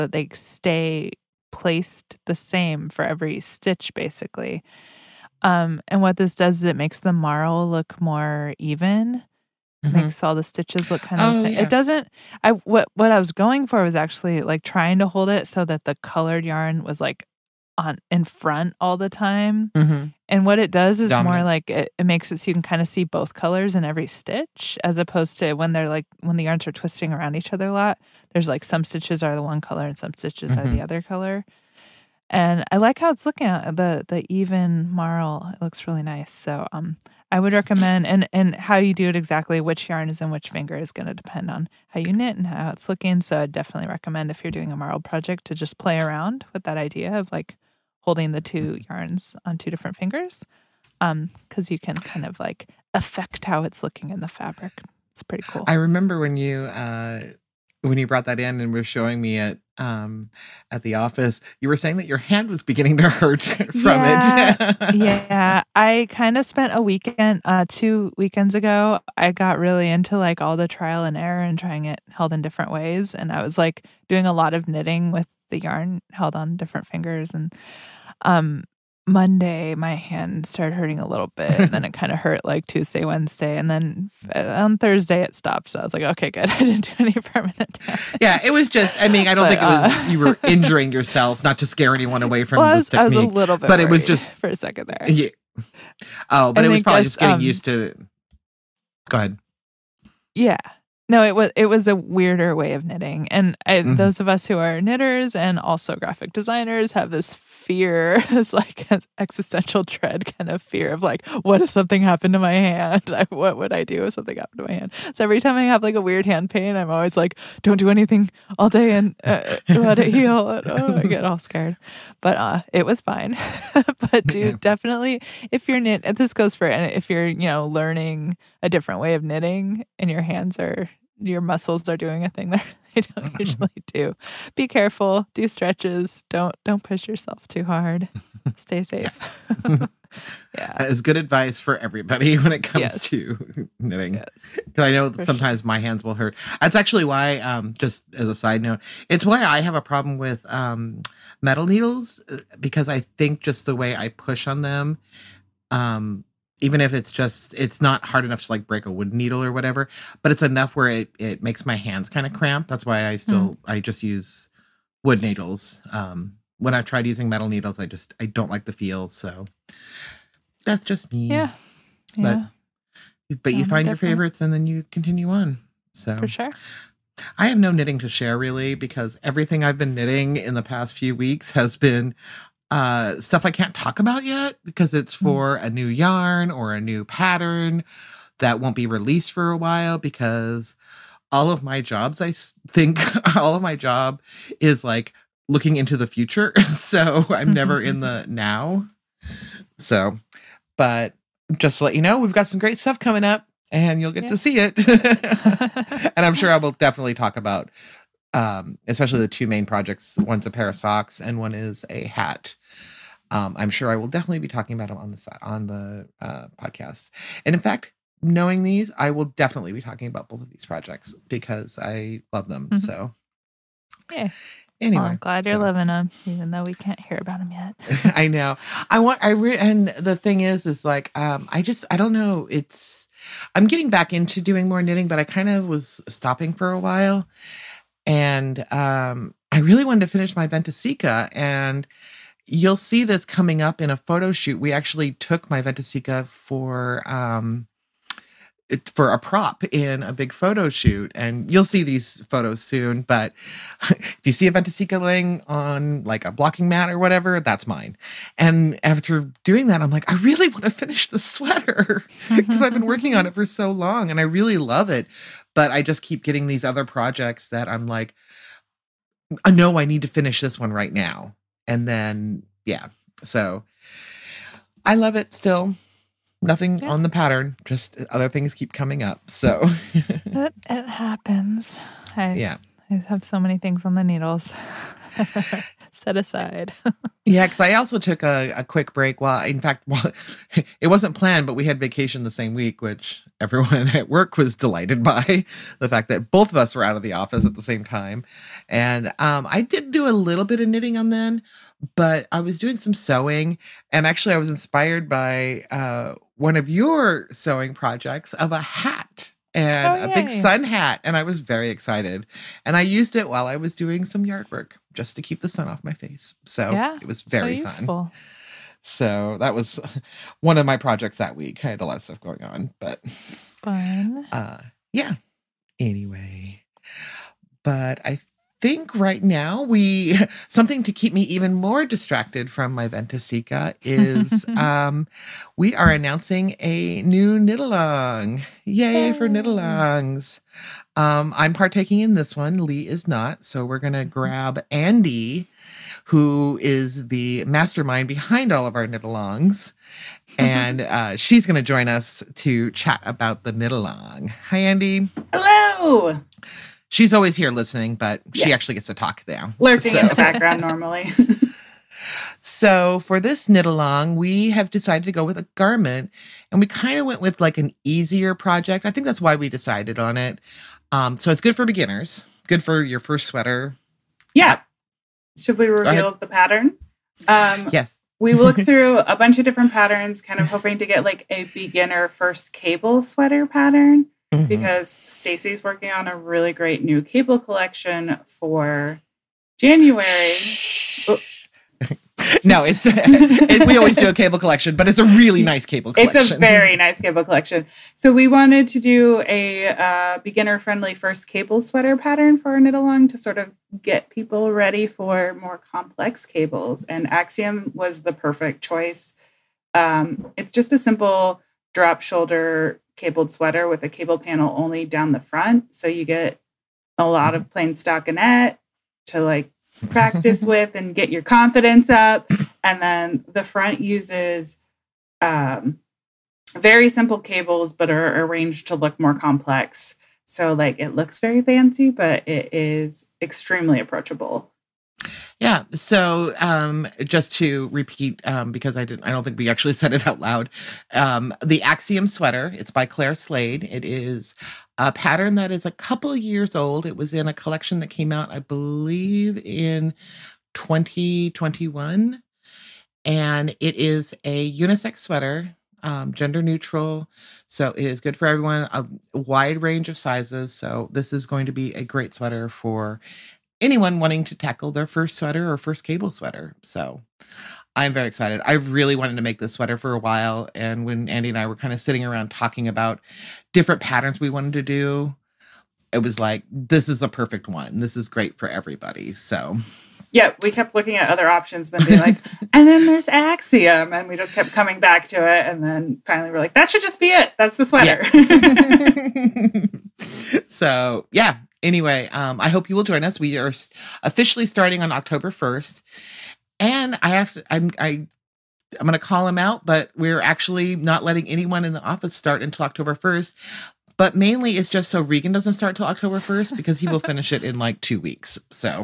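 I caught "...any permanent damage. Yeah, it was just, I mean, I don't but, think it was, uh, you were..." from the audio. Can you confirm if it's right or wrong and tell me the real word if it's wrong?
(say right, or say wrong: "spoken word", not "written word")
right.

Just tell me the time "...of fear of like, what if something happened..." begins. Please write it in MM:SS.
01:50.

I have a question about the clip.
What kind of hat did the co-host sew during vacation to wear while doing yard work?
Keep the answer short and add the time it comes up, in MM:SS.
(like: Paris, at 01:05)
sun hat, at 05:10.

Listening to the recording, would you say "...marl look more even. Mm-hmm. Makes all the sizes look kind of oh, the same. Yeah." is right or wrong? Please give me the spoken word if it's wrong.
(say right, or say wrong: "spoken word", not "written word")
wrong: "stitches", not "sizes".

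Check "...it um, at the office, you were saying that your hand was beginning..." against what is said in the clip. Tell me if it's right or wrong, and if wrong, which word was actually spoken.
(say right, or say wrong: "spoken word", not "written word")
right.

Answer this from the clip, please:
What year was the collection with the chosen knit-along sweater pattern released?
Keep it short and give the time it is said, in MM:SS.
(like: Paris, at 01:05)
2021, at 07:30.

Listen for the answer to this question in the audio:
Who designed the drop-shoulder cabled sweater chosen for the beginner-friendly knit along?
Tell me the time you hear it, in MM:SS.
07:22.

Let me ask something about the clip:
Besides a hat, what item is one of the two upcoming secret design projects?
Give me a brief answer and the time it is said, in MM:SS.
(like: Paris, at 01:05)
socks, at 03:30.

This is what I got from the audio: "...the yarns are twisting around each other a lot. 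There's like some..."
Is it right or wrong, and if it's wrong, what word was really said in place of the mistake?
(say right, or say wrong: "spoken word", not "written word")
right.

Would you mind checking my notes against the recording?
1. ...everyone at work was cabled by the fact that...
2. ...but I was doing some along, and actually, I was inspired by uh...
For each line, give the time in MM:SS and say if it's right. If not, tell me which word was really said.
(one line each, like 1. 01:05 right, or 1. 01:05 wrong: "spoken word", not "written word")
1. 04:53 wrong: "delighted", not "cabled"
2. 05:01 wrong: "sewing", not "along".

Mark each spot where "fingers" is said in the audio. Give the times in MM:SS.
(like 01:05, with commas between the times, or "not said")
00:40, 00:49, 01:16.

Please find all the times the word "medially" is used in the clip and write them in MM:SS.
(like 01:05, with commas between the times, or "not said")
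not said.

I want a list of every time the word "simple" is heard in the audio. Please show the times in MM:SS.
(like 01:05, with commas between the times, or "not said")
06:50, 07:06.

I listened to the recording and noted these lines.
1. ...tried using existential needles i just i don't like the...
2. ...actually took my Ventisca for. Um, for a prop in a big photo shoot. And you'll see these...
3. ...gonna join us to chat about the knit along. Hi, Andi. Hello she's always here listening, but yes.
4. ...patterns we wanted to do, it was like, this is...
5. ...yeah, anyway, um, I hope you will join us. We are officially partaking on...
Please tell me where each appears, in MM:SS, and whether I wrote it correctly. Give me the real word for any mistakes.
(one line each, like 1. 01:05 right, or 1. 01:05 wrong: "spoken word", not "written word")
1. 02:46 wrong: "metal", not "existential"
2. 04:04 right
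3. 05:51 right
4. 07:53 right
5. 08:11 wrong: "starting", not "partaking".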